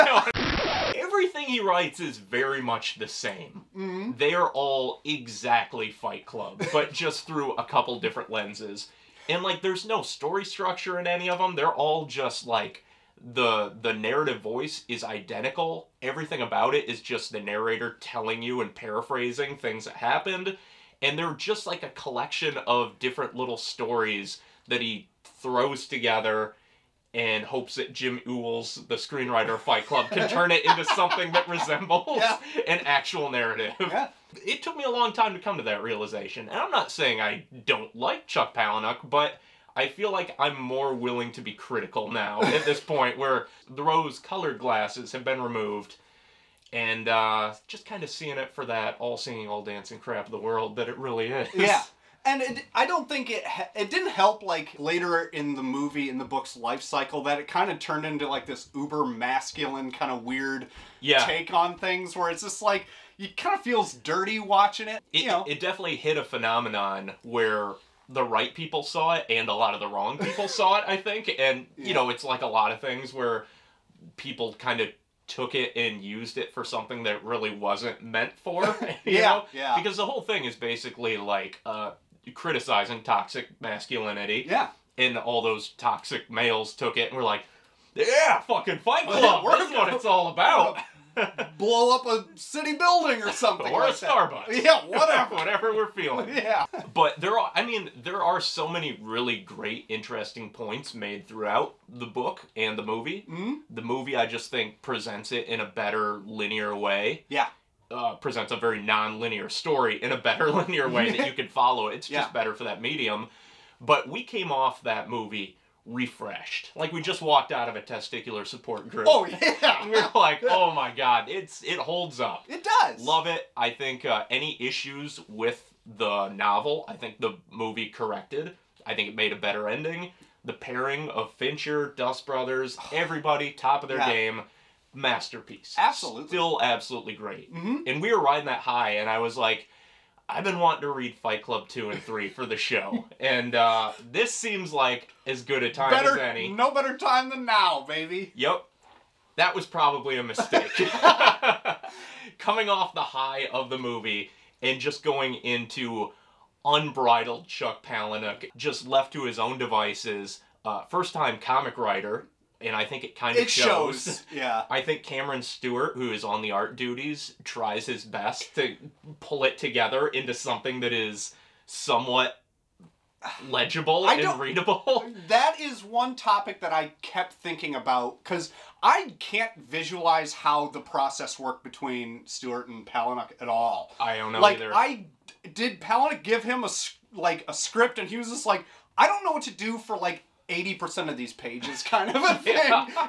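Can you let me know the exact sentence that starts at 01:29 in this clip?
Well, yeah, we're That's gonna, what it's all about blow up a city building or something.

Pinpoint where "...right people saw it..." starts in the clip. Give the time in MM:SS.
01:08.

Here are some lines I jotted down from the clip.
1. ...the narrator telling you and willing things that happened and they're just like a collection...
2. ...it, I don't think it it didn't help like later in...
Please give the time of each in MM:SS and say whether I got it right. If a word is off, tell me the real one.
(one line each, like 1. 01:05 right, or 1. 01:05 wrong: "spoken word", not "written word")
1. 00:17 wrong: "paraphrasing", not "willing"
2. 00:52 right.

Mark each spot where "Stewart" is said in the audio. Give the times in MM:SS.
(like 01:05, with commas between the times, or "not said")
02:45, 03:02.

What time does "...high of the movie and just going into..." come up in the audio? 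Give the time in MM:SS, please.
02:33.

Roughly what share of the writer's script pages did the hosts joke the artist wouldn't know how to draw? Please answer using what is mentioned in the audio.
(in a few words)
80%.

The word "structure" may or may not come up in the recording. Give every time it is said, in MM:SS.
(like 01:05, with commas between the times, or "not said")
00:10.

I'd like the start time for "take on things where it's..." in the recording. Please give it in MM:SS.
01:01.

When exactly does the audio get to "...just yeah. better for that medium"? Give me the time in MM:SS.
01:52.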